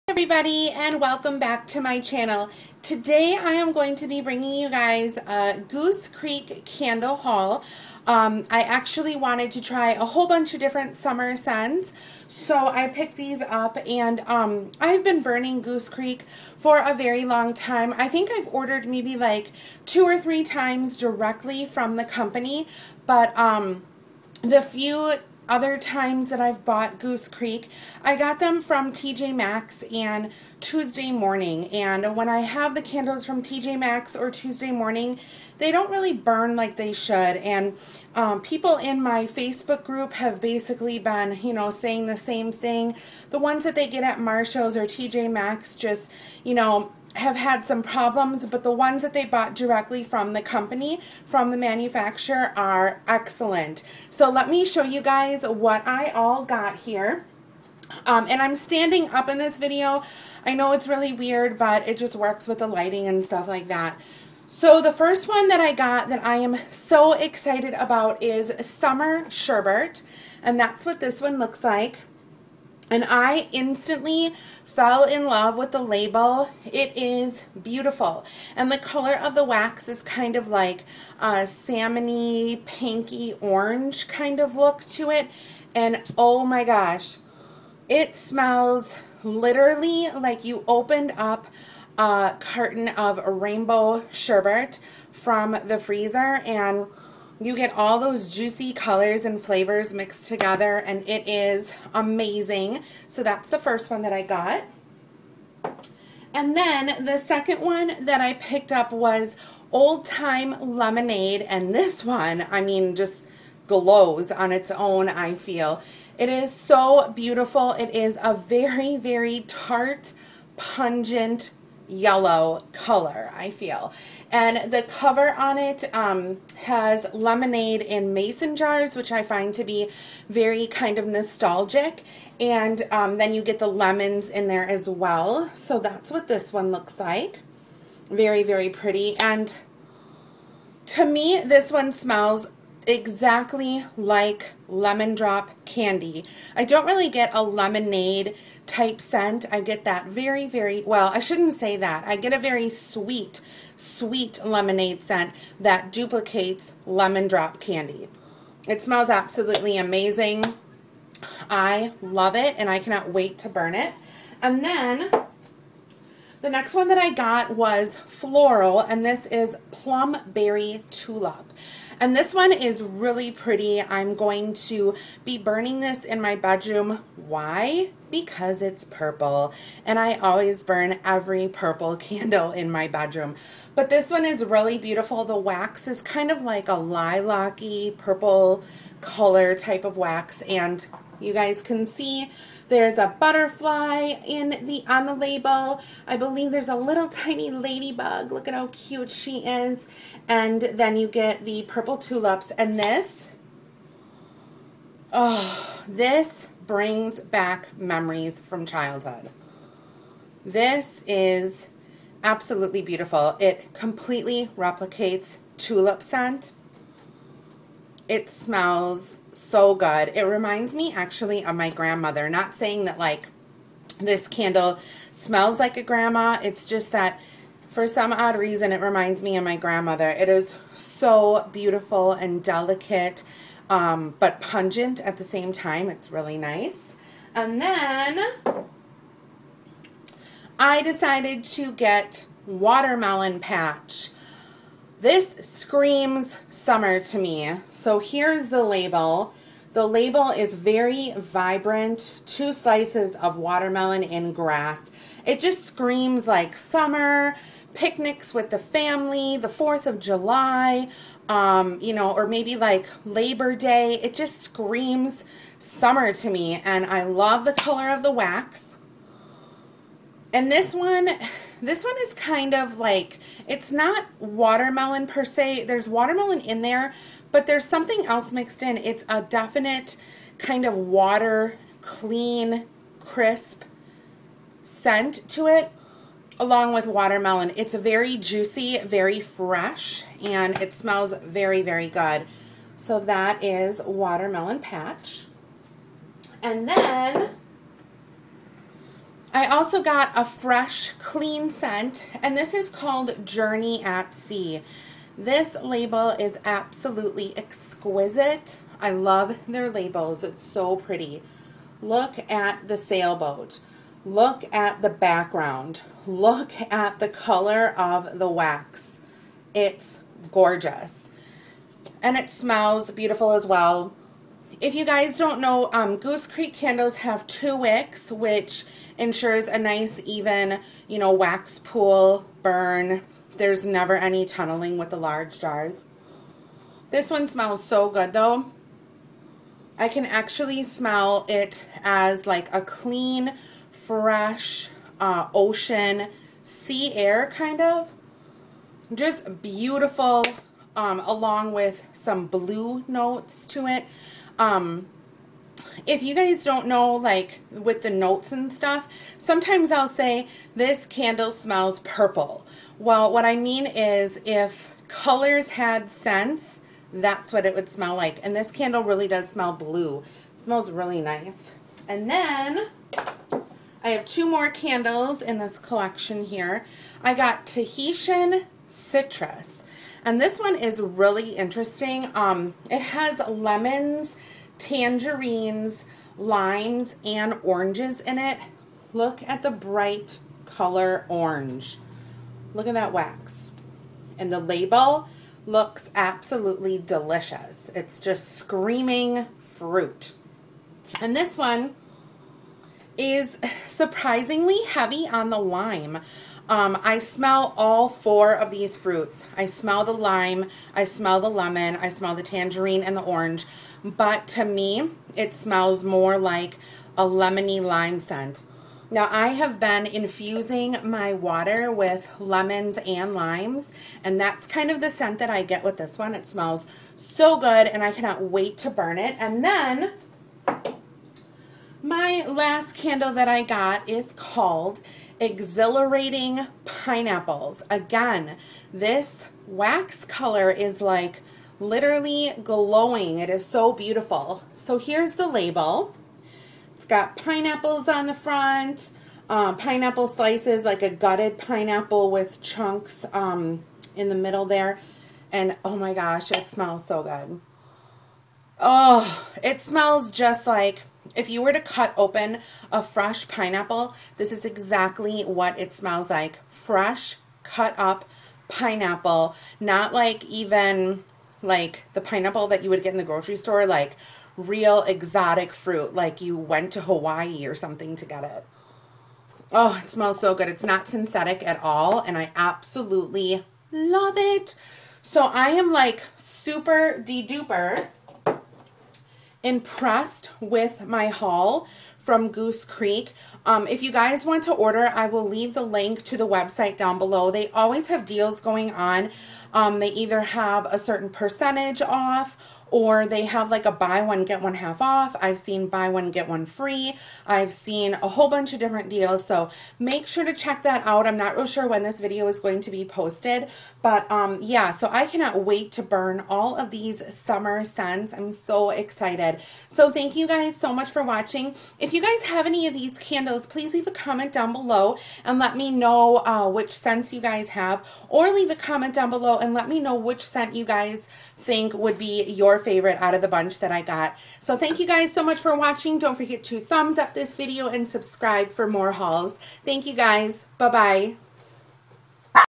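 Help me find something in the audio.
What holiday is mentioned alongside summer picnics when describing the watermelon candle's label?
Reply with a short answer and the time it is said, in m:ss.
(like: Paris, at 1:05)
4th of July, at 4:19.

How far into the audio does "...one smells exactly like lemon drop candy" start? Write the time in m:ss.
2:21.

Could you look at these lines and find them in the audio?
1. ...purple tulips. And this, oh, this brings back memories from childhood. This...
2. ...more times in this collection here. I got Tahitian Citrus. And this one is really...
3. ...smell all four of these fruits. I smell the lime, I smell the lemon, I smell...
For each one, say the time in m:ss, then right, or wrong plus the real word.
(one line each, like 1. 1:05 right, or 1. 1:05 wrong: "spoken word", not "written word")
1. 3:21 right
2. 6:14 wrong: "candles", not "times"
3. 6:46 right.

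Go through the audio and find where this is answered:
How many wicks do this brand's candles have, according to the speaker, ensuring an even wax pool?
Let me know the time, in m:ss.
5:27.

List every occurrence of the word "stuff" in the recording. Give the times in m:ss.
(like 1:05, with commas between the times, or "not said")
1:03, 5:58.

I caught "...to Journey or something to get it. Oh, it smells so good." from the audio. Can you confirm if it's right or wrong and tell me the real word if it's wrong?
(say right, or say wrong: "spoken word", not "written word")
wrong: "Hawaii", not "Journey".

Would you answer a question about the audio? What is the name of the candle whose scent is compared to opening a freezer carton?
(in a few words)
Summer Sherbert.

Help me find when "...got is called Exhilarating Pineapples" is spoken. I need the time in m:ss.
7:13.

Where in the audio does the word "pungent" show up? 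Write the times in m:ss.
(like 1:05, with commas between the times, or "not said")
2:00, 3:54.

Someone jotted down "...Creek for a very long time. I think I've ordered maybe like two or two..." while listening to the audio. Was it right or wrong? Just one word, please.
wrong.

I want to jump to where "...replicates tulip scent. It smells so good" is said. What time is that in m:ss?
3:34.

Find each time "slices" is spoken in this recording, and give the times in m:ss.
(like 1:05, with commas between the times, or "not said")
4:12, 7:30.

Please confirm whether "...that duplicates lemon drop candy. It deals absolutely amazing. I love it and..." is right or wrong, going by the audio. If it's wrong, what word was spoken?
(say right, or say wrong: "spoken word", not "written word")
wrong: "smells", not "deals".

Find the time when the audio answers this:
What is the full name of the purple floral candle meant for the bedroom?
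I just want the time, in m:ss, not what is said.
2:49.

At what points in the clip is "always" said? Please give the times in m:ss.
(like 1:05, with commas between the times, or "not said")
3:00, 8:17.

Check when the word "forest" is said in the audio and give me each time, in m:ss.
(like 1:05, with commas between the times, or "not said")
not said.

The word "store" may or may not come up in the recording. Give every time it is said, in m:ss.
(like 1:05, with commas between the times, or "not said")
7:53.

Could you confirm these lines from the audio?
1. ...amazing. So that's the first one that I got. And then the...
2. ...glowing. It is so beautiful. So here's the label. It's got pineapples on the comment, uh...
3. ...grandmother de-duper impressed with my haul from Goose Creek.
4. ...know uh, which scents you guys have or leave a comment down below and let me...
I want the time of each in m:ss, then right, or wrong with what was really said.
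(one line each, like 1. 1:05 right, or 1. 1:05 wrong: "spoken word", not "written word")
1. 1:41 right
2. 7:22 wrong: "front", not "comment"
3. 8:06 wrong: "super", not "grandmother"
4. 8:45 right.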